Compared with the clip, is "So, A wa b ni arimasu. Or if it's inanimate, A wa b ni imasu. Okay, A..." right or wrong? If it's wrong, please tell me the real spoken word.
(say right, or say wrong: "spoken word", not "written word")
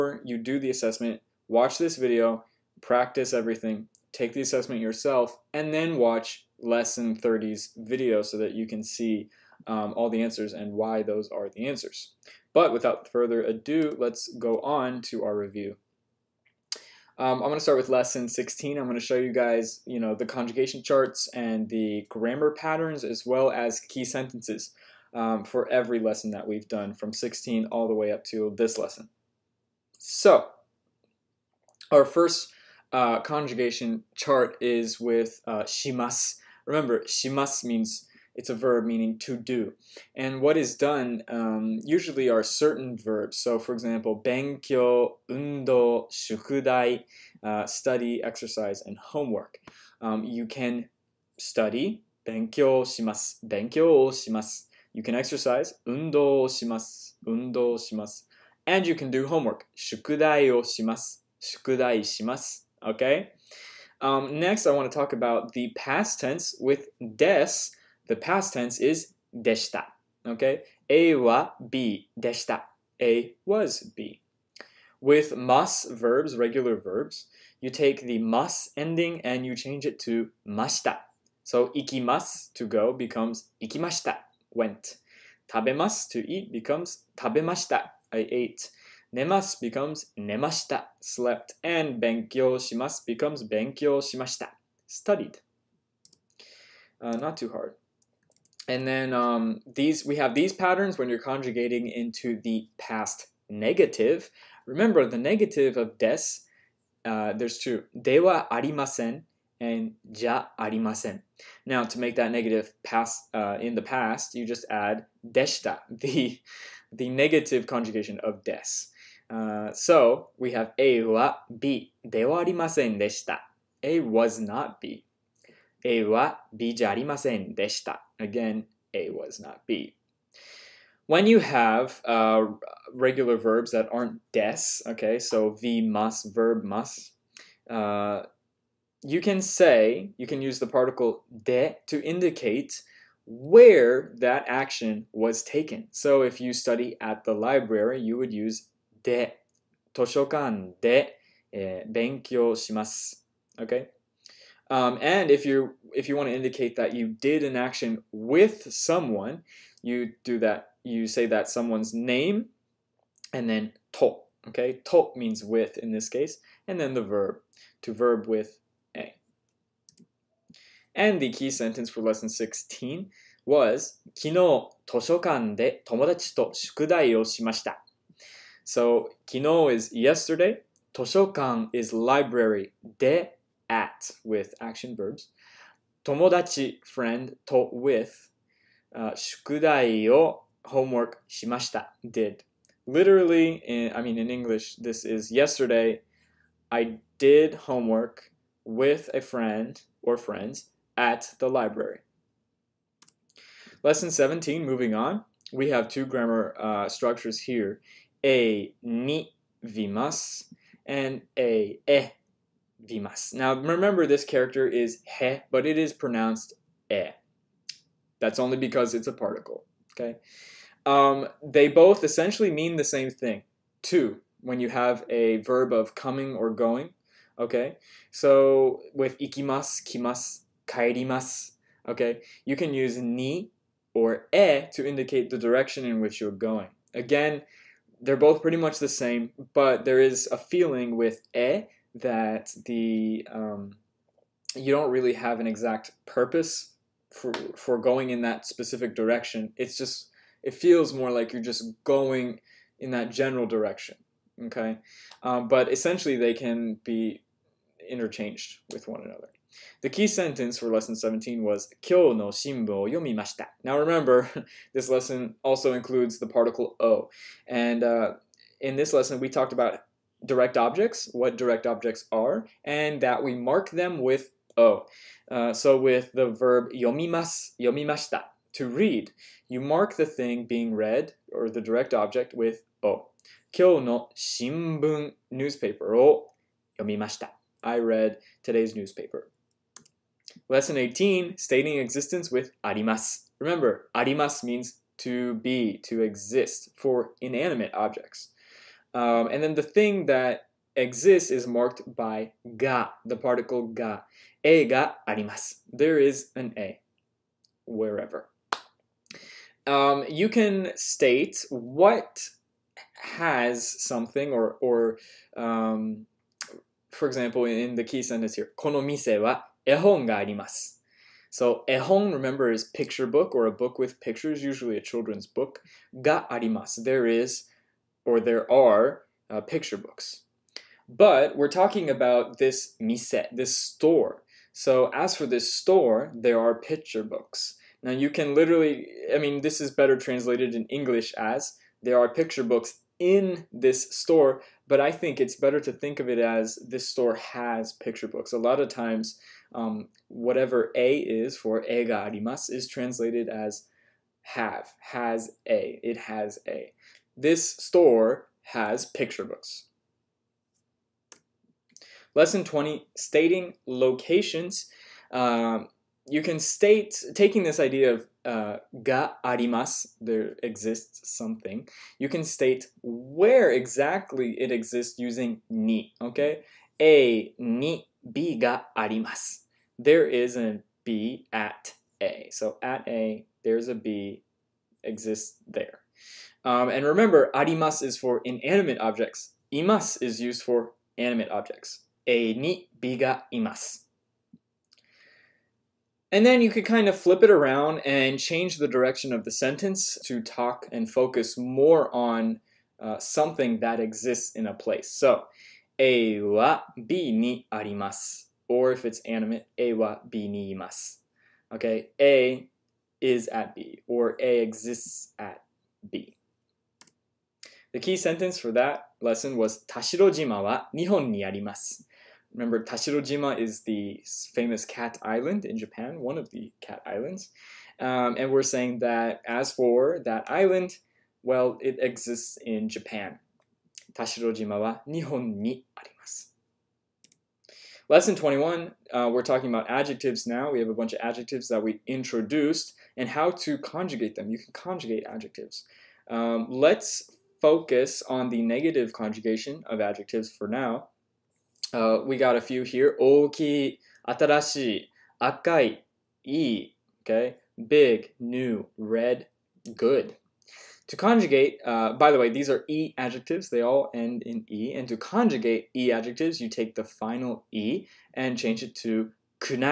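wrong: "animate", not "inanimate".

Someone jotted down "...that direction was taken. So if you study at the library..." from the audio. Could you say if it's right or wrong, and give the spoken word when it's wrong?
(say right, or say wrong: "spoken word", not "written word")
wrong: "action", not "direction".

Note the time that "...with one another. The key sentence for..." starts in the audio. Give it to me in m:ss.
4:18.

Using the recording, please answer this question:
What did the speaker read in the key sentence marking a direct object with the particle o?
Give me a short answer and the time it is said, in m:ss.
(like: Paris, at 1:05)
today's newspaper, at 4:48.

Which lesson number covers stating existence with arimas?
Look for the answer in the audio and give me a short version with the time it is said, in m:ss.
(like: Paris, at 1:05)
Lesson 18, at 4:50.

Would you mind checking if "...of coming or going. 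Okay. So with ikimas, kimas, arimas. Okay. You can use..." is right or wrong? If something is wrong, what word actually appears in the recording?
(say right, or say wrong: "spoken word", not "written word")
wrong: "kaerimas", not "arimas".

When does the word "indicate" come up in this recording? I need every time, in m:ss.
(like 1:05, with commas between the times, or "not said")
2:22, 2:36, 3:54.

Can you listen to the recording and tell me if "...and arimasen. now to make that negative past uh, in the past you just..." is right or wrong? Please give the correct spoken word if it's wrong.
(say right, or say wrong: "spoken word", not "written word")
right.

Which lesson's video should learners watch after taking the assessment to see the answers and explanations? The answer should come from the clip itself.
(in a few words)
Lesson 30.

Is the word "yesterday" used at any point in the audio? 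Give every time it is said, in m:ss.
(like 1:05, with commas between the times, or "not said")
2:59, 3:15.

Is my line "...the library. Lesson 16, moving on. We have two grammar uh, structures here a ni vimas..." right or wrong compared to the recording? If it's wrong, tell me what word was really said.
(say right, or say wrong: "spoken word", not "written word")
wrong: "17", not "16".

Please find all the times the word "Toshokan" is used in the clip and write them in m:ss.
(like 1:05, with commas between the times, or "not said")
3:00.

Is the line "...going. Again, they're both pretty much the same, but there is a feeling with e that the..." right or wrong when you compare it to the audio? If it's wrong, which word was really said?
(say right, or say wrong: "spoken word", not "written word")
right.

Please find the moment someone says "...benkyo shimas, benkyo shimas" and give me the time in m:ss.
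0:52.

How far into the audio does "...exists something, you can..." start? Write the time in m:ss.
6:10.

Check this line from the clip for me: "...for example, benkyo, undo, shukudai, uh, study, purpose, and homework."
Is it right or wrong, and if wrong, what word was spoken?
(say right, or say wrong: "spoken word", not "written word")
wrong: "exercise", not "purpose".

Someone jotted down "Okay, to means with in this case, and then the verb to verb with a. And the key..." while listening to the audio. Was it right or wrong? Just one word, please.
right.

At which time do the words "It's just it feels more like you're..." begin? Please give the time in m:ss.
4:09.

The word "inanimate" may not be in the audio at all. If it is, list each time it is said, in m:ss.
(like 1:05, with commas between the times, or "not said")
4:57, 6:28.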